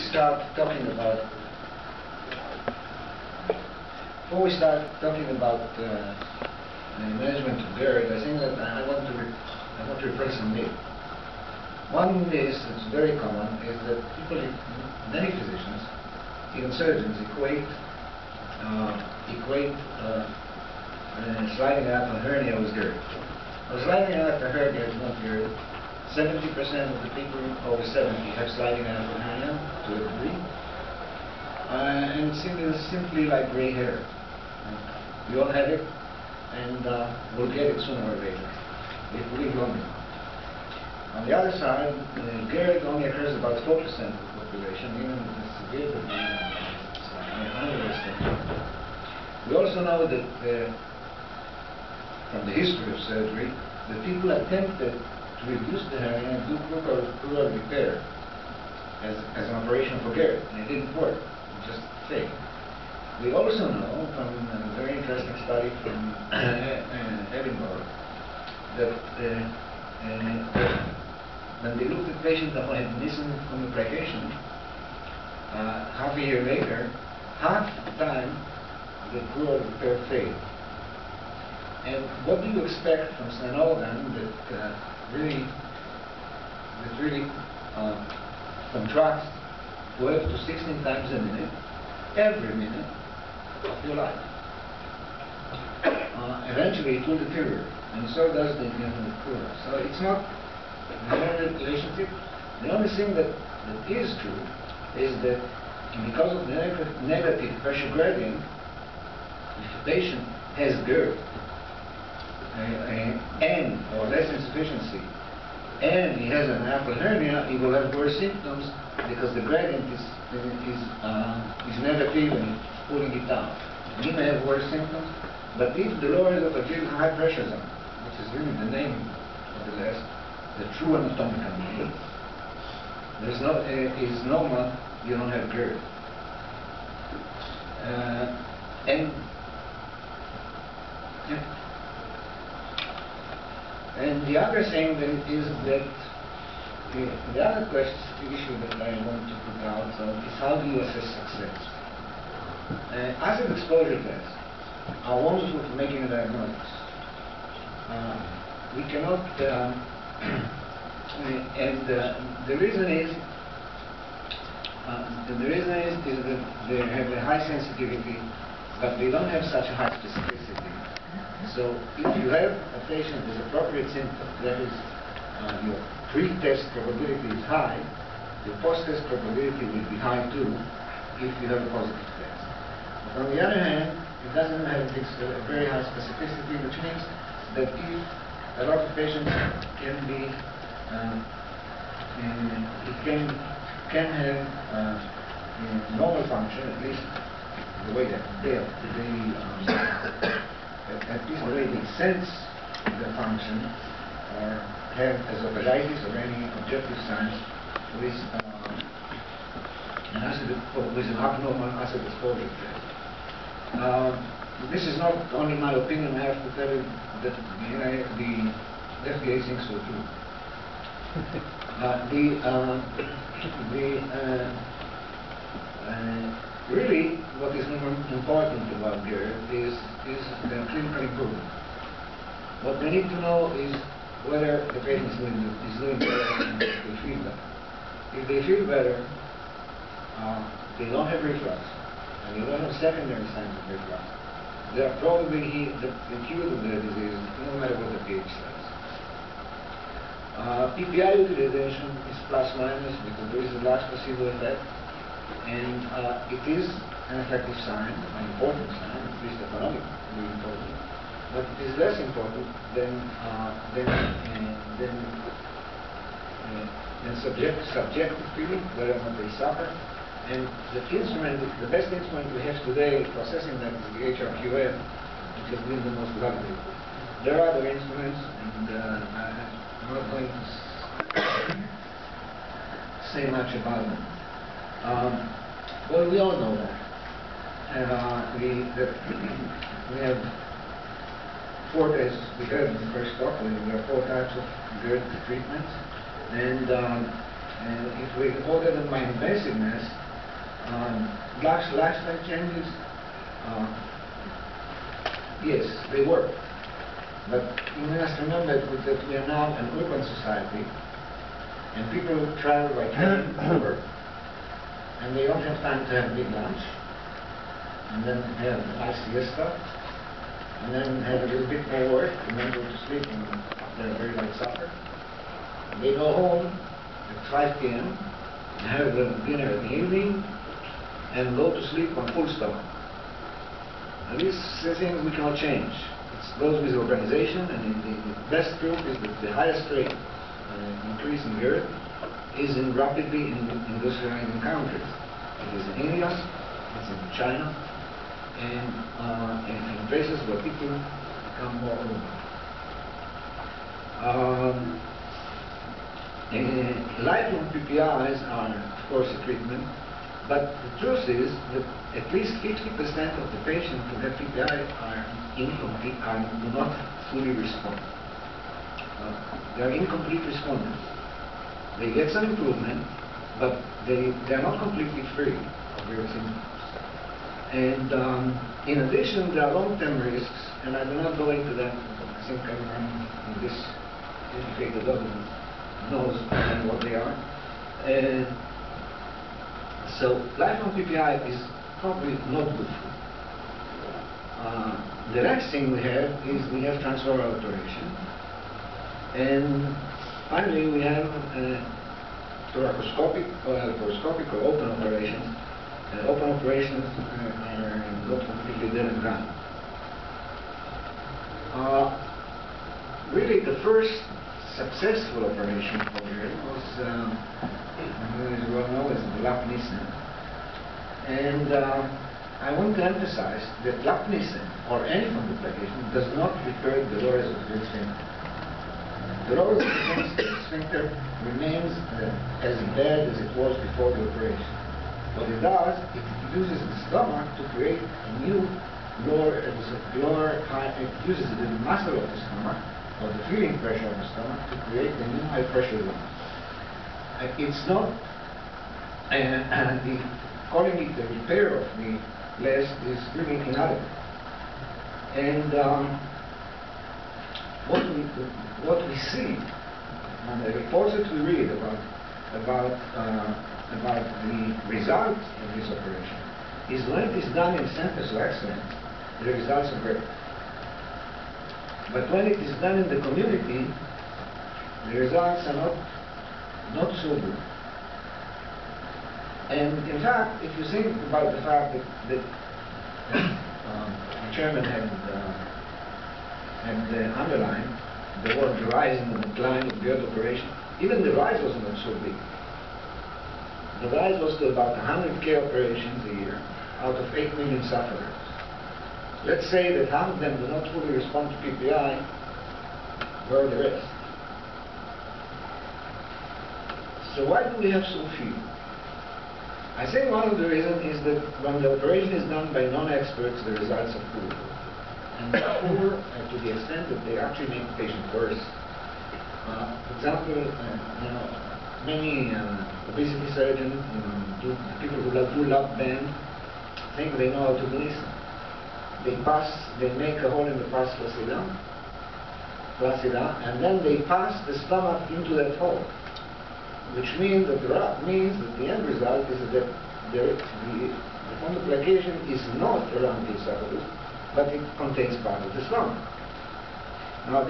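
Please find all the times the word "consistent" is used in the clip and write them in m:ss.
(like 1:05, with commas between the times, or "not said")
not said.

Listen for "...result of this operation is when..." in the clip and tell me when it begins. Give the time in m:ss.
7:44.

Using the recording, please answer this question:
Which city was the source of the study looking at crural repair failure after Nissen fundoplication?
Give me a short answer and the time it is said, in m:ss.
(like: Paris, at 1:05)
Edinburgh, at 1:07.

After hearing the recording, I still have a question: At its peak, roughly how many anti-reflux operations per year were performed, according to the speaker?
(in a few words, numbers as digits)
100k.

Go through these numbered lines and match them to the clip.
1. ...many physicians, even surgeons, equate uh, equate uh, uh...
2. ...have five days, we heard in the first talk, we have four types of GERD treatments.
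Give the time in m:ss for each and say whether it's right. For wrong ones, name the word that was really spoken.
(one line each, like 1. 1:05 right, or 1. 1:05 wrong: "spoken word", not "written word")
1. 0:15 right
2. 4:50 wrong: "four", not "five".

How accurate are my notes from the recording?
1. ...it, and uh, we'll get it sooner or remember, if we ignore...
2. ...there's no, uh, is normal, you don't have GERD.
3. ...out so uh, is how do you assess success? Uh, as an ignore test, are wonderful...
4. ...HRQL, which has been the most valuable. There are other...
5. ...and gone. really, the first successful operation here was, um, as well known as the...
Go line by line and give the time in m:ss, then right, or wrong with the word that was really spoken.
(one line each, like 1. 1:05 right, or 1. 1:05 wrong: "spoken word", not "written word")
1. 0:35 wrong: "later", not "remember"
2. 2:13 right
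3. 2:29 wrong: "exposure", not "ignore"
4. 4:34 right
5. 6:48 right.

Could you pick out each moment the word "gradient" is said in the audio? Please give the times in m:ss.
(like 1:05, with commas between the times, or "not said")
1:47, 1:59.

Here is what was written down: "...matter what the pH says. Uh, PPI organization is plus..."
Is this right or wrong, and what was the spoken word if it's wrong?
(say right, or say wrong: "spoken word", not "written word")
wrong: "utilization", not "organization".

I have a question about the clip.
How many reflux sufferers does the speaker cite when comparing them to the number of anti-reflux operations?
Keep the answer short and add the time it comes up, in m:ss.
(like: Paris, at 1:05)
8 million, at 8:17.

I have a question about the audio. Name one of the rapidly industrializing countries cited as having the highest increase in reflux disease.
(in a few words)
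India.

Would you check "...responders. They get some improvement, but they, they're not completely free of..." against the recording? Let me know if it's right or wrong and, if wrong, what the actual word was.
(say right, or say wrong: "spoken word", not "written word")
right.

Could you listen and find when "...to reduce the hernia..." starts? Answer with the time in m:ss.
0:55.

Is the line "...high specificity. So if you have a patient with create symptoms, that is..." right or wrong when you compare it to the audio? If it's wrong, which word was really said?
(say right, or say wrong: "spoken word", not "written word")
wrong: "appropriate", not "create".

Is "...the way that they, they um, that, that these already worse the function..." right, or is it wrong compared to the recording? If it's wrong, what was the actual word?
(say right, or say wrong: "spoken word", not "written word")
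wrong: "sense", not "worse".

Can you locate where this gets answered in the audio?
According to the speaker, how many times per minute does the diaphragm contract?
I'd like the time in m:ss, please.
1:29.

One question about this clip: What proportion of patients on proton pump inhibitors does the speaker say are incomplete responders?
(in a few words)
50%.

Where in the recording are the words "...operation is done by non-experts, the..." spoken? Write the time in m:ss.
8:31.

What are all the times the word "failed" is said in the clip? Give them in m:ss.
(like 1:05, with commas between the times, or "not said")
1:02, 1:20.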